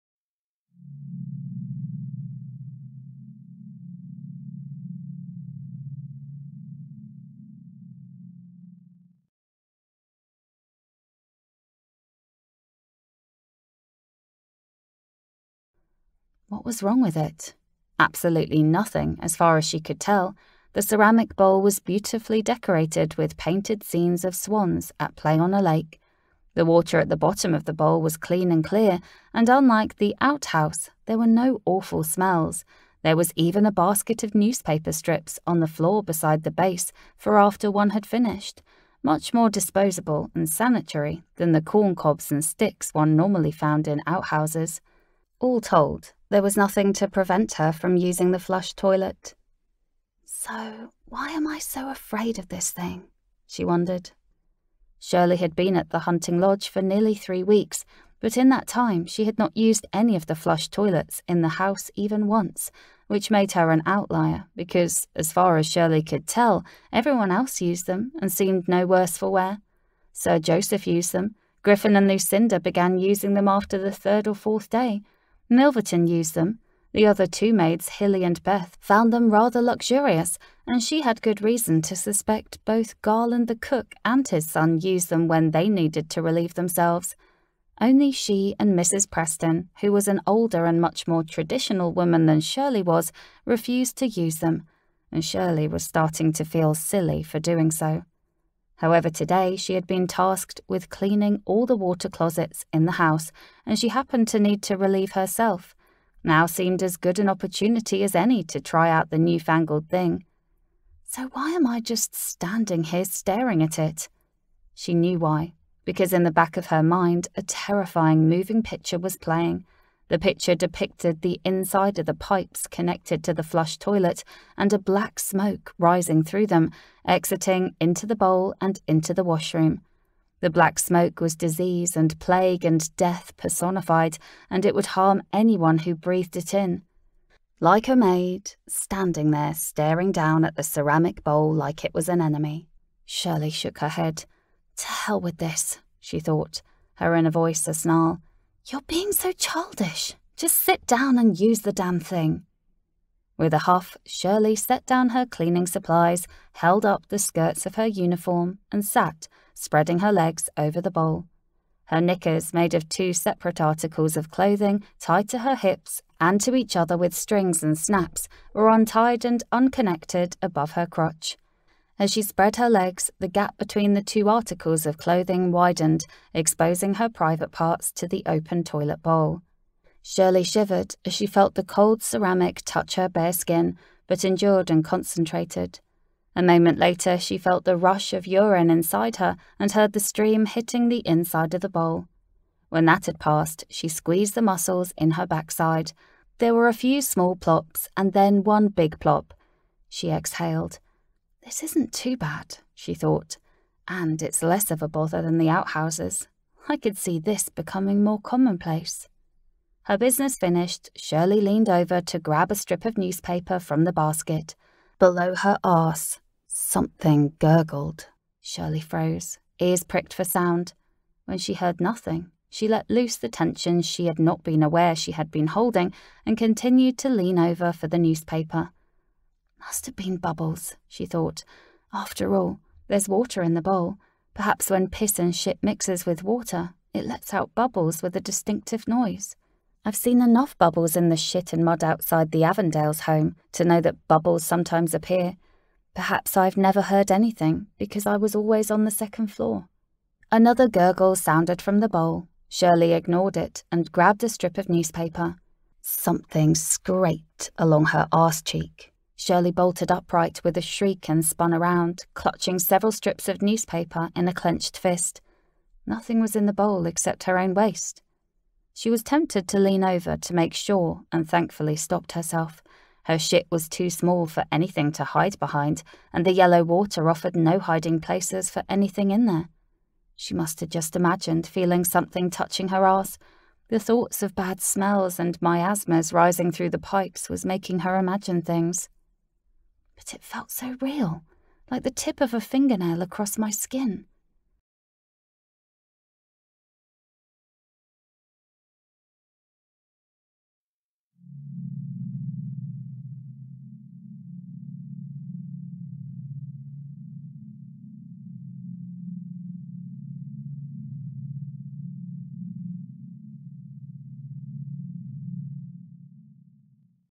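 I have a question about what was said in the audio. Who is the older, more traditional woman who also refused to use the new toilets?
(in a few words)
Mrs. Preston.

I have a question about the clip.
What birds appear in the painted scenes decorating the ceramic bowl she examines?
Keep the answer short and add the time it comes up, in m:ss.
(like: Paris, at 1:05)
Swans, at 0:24.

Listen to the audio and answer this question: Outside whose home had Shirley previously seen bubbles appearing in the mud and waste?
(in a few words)
The Avondales.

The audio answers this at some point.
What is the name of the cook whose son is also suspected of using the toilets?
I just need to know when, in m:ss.
1:23.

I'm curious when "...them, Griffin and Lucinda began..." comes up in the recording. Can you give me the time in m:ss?
1:11.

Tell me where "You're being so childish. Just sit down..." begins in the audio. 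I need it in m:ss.
2:28.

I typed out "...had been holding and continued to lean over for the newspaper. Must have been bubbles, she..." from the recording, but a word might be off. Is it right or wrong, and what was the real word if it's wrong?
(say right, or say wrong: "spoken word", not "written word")
right.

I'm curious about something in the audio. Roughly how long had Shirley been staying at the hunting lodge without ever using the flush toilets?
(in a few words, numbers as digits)
Nearly 3 weeks.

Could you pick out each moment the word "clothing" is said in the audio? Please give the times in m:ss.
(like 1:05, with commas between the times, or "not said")
2:44, 2:54.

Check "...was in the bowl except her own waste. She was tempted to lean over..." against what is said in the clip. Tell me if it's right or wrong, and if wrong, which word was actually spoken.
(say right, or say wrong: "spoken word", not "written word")
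right.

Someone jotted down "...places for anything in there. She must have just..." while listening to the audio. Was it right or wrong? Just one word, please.
right.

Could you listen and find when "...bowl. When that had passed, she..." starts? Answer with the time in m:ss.
3:11.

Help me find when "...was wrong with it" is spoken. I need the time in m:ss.
0:16.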